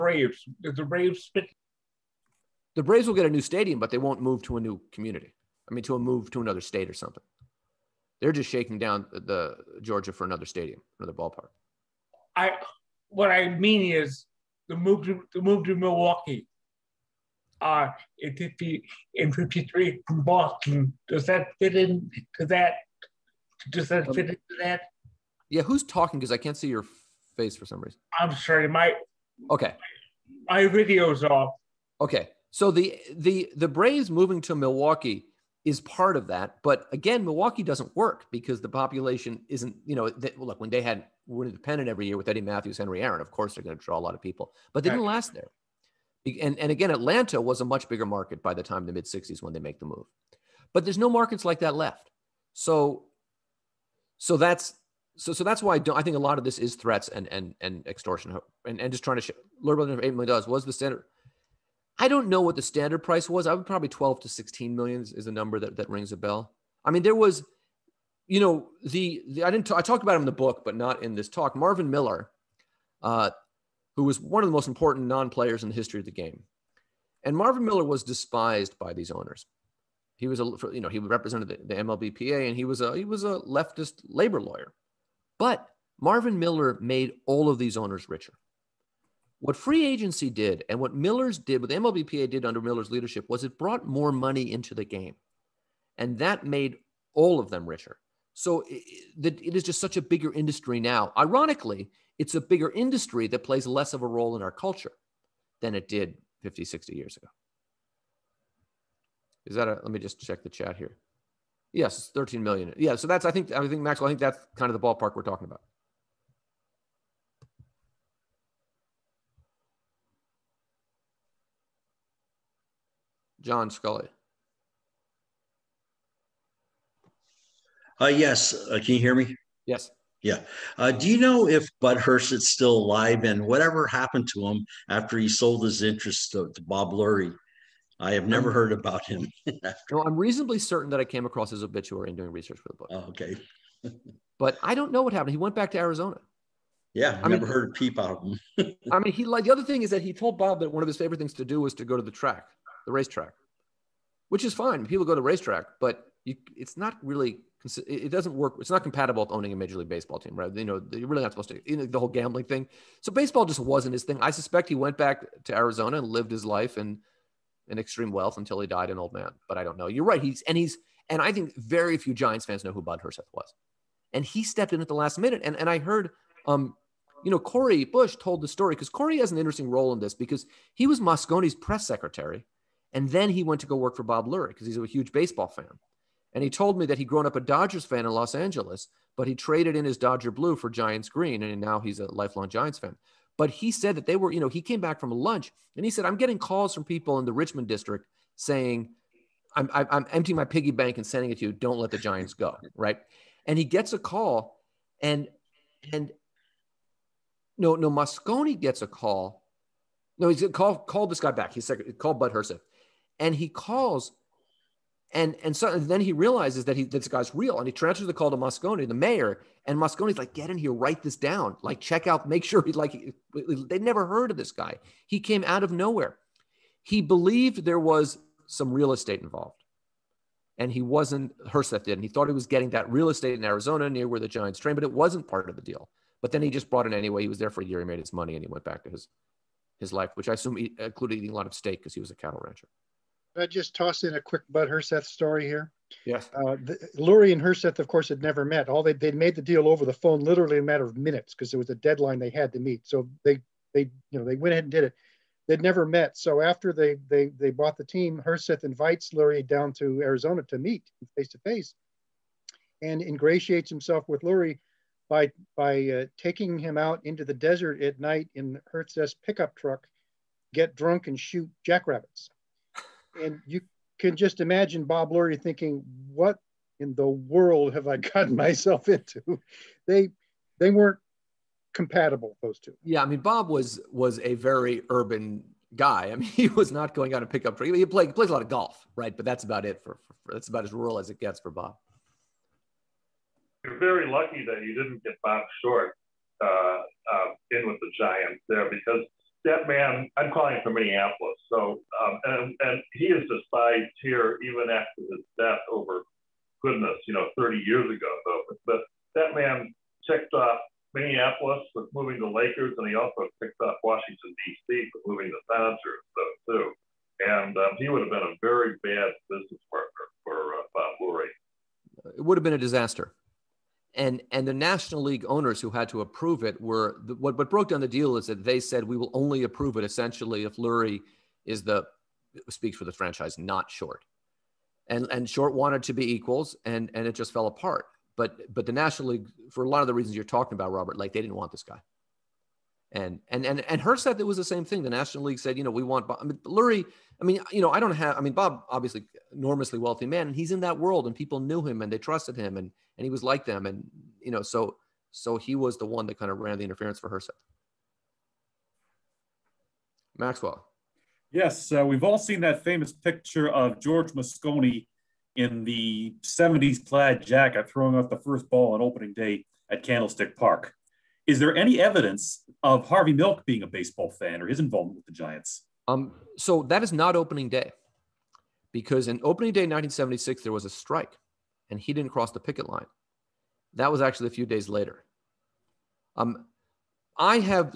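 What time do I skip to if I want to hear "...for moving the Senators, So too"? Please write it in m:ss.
5:14.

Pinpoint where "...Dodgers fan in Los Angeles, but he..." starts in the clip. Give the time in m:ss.
3:07.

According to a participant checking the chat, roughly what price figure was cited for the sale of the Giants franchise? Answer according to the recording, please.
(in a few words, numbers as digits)
13 million.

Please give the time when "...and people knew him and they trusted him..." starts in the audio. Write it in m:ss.
5:51.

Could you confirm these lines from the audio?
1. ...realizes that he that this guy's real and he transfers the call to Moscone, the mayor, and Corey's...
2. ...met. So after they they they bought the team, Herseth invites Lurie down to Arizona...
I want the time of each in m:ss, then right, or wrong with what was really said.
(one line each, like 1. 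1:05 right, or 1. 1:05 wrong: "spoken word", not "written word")
1. 3:36 wrong: "Moscone", not "Corey"
2. 4:15 right.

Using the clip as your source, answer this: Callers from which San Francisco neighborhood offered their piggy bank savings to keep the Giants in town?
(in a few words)
Richmond district.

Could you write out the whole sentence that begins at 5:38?
But but the national league, for a lot of the reasons you're talking about, Robert, like they didn't want this guy.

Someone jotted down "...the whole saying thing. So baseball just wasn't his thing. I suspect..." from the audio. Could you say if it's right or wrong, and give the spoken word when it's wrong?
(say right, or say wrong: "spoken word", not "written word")
wrong: "gambling", not "saying".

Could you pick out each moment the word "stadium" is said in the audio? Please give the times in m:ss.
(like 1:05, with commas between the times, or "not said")
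0:03, 0:10.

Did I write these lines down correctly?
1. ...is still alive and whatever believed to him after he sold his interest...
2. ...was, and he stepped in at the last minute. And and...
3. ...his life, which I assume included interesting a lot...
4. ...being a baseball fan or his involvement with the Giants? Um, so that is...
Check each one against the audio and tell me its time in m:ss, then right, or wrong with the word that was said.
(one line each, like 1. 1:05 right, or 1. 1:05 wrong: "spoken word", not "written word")
1. 2:12 wrong: "happened", not "believed"
2. 2:53 right
3. 3:59 wrong: "eating", not "interesting"
4. 6:13 right.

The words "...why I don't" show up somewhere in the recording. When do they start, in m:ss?
0:55.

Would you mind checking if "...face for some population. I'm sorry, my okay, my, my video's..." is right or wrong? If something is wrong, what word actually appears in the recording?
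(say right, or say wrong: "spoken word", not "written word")
wrong: "reason", not "population".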